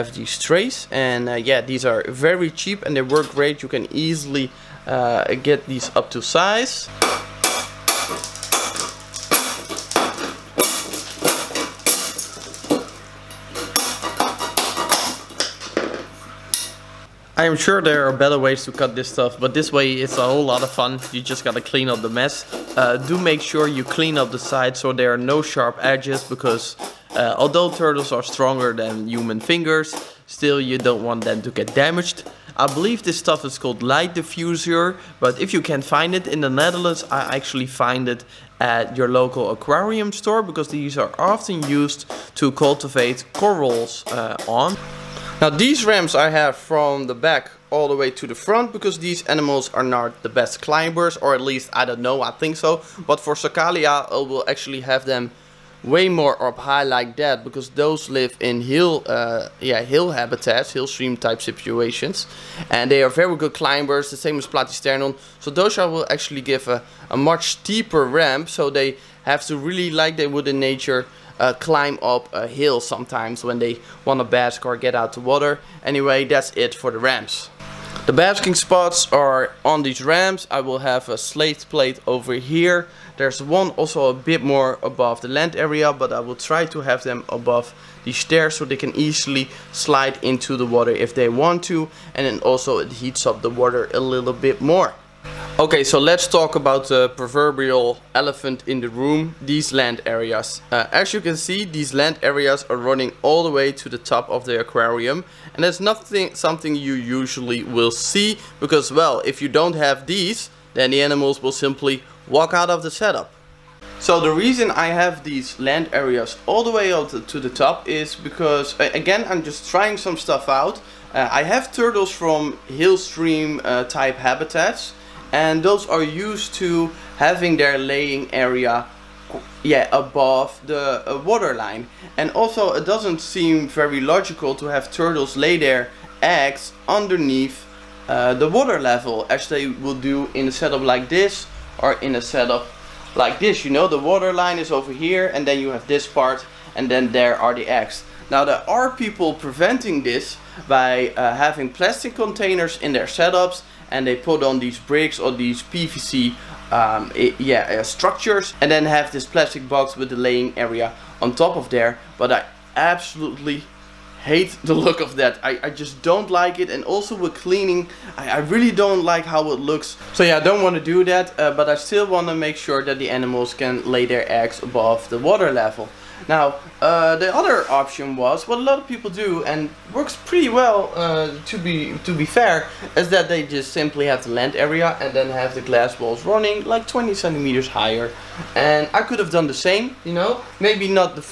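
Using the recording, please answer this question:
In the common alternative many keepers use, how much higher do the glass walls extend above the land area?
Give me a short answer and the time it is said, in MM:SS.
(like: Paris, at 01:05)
20 centimeters, at 03:06.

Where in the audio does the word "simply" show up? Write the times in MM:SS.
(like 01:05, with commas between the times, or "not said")
01:51, 03:03.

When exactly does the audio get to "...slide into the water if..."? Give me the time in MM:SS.
01:29.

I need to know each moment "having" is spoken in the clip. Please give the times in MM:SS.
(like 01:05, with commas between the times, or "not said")
02:07, 02:31.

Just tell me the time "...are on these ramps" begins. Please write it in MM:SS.
01:19.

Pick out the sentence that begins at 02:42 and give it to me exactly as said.
But I absolutely hate the look of that.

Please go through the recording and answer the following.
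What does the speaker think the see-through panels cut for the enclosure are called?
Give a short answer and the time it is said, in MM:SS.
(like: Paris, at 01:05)
Light diffuser, at 00:33.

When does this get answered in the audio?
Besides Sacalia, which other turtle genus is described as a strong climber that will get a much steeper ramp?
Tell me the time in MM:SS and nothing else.
01:04.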